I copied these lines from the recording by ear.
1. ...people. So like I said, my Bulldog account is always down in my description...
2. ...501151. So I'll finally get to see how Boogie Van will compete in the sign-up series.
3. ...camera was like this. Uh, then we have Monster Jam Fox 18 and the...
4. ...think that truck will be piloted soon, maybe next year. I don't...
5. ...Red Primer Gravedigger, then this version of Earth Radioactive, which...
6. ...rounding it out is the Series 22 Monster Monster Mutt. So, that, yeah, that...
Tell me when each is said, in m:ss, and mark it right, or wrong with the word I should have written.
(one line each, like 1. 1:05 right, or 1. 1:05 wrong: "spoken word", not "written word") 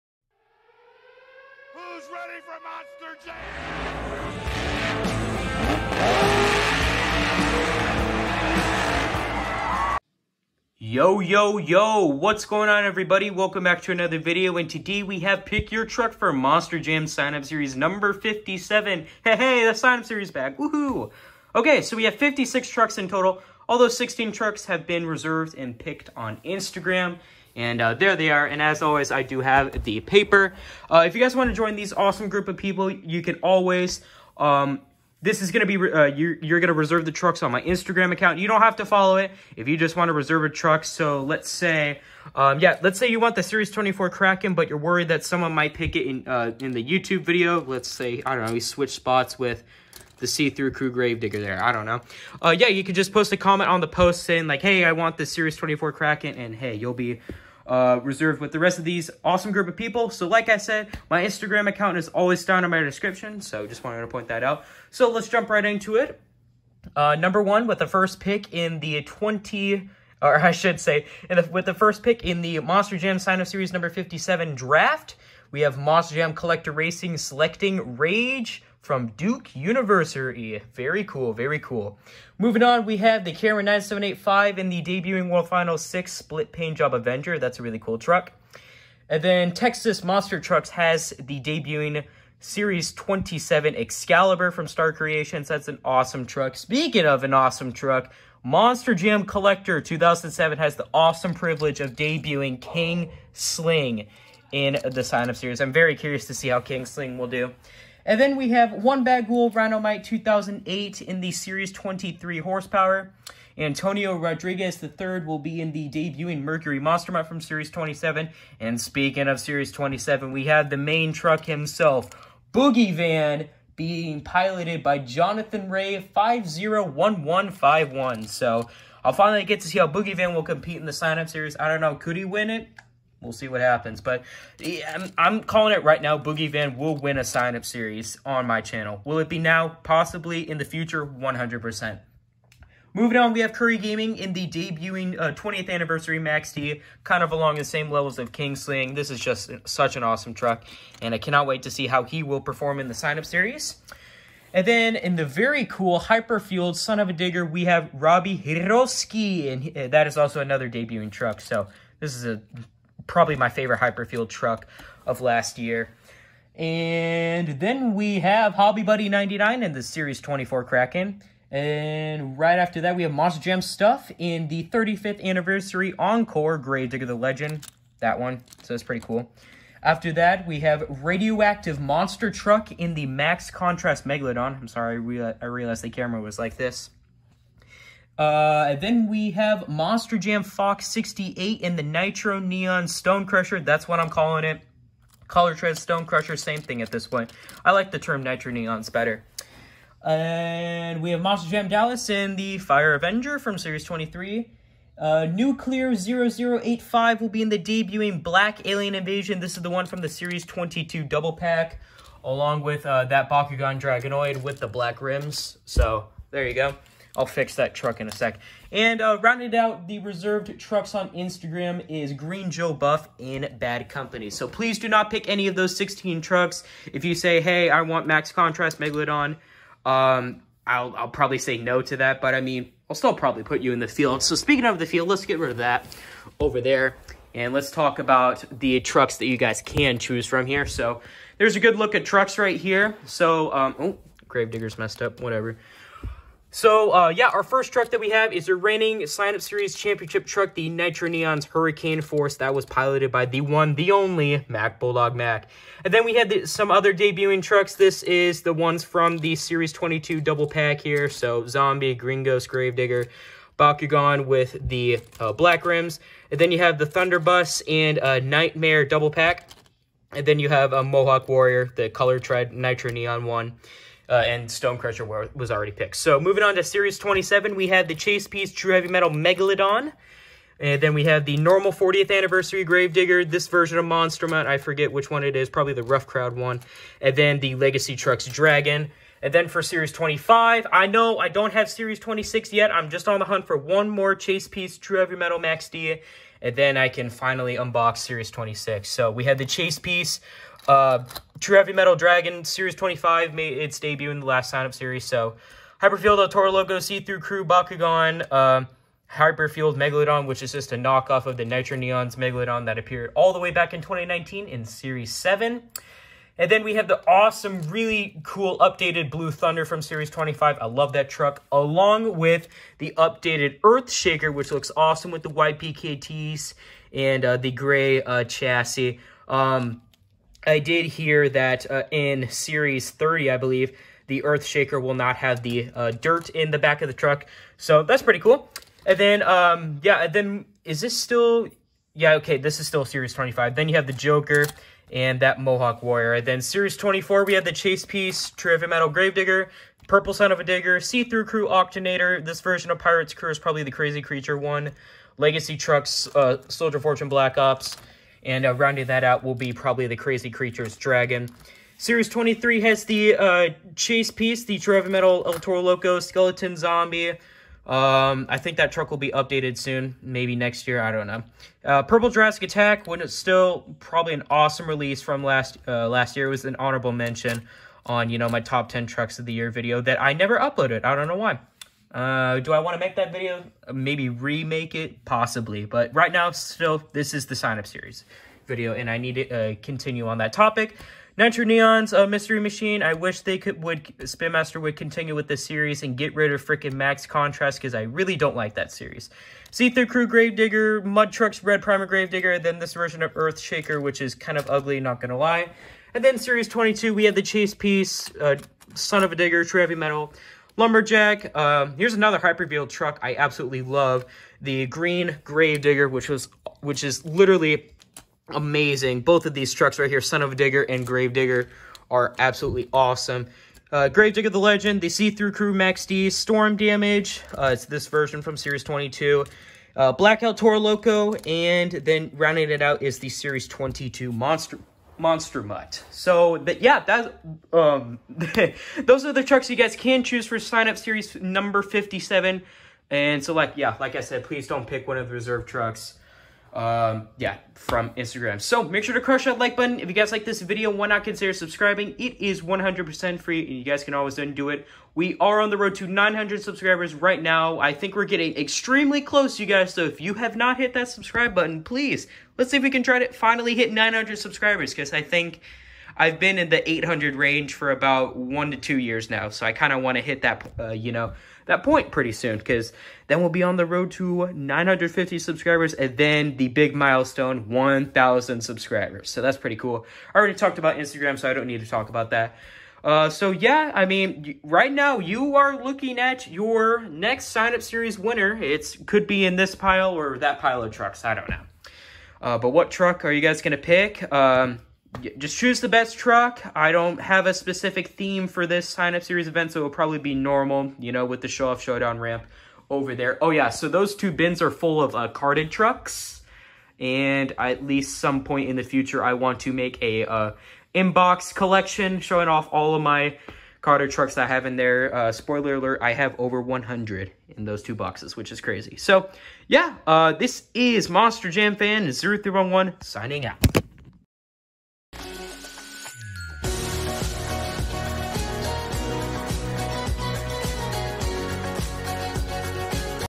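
1. 0:59 wrong: "Instagram", not "Bulldog"
2. 2:06 right
3. 3:05 wrong: "68", not "18"
4. 6:08 wrong: "updated", not "piloted"
5. 6:41 wrong: "Shaker", not "Radioactive"
6. 7:12 right.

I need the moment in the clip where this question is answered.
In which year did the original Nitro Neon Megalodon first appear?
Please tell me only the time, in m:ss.
5:13.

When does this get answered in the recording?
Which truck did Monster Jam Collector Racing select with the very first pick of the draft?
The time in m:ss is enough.
1:17.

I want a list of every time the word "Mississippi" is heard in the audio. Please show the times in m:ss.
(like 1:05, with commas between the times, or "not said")
not said.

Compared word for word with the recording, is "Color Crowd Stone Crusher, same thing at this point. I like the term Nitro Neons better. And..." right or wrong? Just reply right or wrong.
wrong.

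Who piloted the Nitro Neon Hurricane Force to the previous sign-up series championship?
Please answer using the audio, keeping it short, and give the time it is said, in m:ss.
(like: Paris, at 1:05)
Bulldog Mac, at 4:14.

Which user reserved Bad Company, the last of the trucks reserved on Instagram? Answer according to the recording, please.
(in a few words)
Green Joe Buff.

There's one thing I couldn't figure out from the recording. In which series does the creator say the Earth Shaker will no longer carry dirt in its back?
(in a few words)
Series 30.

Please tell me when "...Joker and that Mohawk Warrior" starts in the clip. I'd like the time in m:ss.
5:43.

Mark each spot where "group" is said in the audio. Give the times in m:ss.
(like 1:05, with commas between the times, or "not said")
0:32, 0:59.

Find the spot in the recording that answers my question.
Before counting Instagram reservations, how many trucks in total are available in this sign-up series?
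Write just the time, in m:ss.
0:22.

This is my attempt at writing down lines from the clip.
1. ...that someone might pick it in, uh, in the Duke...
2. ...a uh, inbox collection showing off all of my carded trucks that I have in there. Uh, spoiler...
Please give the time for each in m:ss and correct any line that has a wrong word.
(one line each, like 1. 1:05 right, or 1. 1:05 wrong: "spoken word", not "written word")
1. 0:45 wrong: "YouTube", not "Duke"
2. 8:29 right.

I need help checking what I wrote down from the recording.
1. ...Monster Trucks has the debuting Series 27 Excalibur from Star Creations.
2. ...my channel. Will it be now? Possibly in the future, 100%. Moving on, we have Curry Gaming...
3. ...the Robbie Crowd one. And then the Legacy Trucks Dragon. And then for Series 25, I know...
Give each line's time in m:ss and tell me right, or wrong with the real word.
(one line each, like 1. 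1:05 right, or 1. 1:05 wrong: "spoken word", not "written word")
1. 1:30 right
2. 2:18 right
3. 4:45 wrong: "Rough", not "Robbie".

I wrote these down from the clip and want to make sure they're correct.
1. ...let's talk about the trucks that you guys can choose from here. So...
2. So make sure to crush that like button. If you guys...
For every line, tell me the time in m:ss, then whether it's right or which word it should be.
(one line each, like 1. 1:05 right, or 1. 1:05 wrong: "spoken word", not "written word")
1. 3:57 right
2. 7:28 right.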